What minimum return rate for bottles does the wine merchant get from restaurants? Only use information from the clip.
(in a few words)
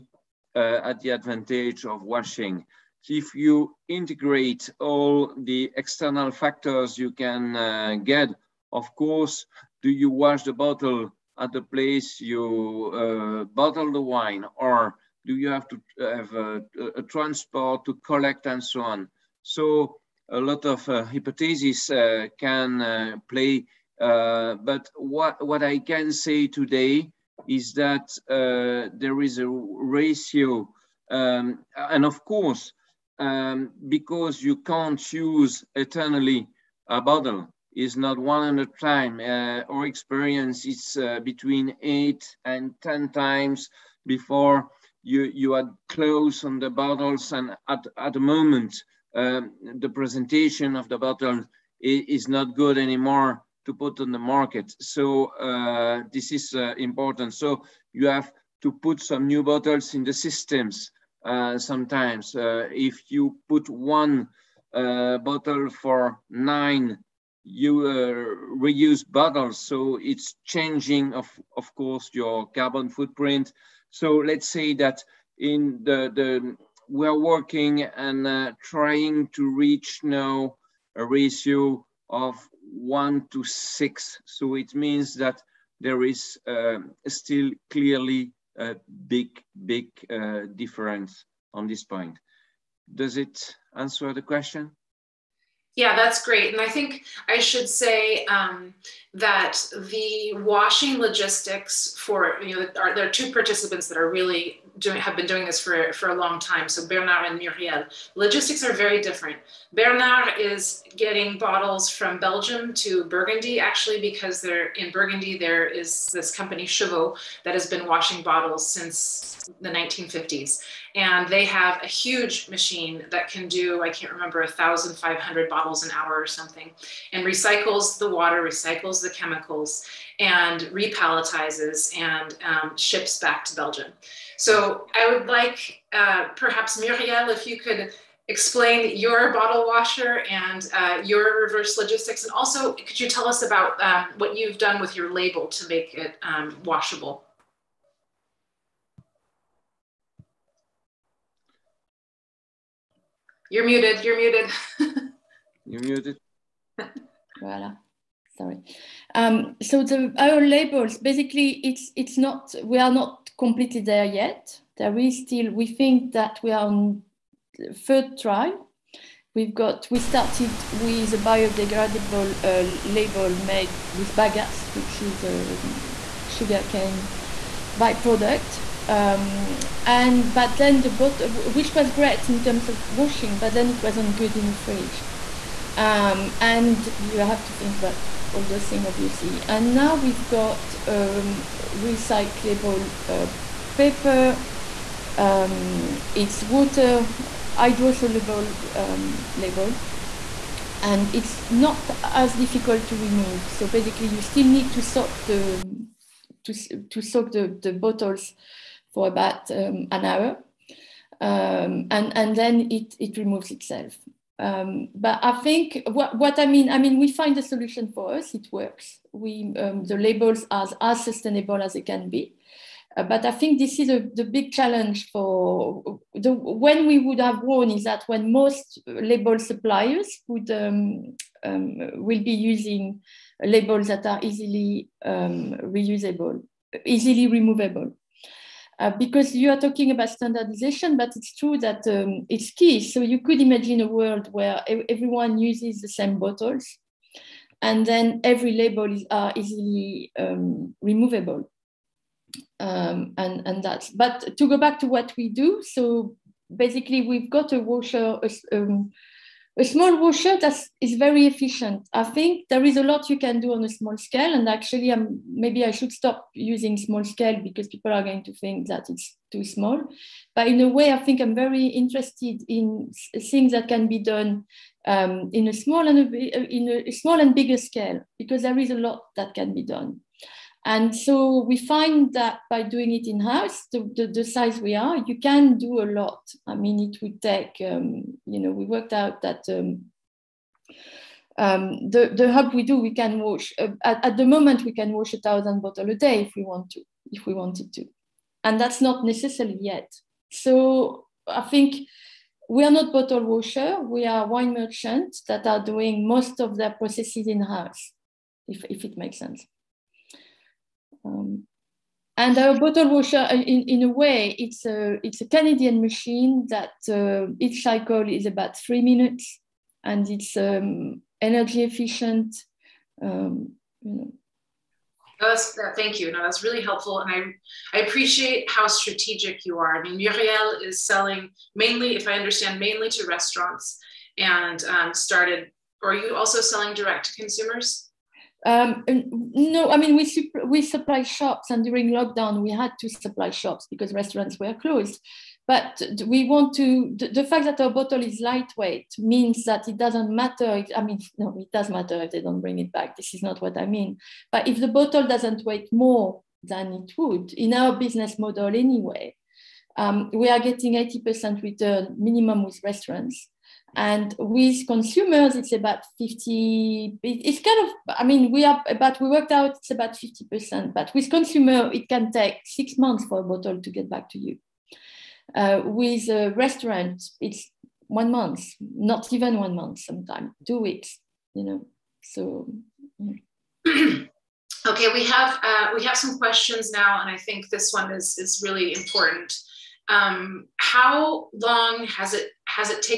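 80%.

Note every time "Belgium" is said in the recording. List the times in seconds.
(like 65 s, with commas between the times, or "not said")
112 s, 133 s.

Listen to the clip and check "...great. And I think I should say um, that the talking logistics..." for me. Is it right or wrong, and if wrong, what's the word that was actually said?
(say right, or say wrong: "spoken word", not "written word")
wrong: "washing", not "talking".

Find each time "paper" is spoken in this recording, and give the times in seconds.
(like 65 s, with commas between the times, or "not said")
193 s.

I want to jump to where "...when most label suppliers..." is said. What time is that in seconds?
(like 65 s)
228 s.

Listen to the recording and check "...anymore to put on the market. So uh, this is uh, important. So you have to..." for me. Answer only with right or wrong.
right.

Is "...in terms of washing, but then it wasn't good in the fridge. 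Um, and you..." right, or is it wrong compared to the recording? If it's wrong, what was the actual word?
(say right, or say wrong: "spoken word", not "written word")
right.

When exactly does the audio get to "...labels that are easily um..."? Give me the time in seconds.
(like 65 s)
233 s.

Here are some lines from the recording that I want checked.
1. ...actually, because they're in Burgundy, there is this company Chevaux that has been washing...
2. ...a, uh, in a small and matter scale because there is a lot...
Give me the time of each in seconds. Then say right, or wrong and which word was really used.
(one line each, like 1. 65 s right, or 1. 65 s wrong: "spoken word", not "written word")
1. 113 s right
2. 276 s wrong: "bigger", not "matter".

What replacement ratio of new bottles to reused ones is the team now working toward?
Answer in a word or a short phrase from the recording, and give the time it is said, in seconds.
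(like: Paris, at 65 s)
1 to 6, at 82 s.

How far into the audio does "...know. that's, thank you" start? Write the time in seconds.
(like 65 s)
323 s.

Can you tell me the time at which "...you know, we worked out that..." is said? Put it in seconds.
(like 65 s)
288 s.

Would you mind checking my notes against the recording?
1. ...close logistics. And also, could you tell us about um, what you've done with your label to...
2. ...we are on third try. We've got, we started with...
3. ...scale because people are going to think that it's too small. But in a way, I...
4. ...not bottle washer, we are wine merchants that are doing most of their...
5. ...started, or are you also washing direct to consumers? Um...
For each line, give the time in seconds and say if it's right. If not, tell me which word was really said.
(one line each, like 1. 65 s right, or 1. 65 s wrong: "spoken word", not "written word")
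1. 141 s wrong: "reverse", not "close"
2. 166 s right
3. 267 s right
4. 302 s right
5. 334 s wrong: "selling", not "washing".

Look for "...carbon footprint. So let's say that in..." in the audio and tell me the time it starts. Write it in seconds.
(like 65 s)
72 s.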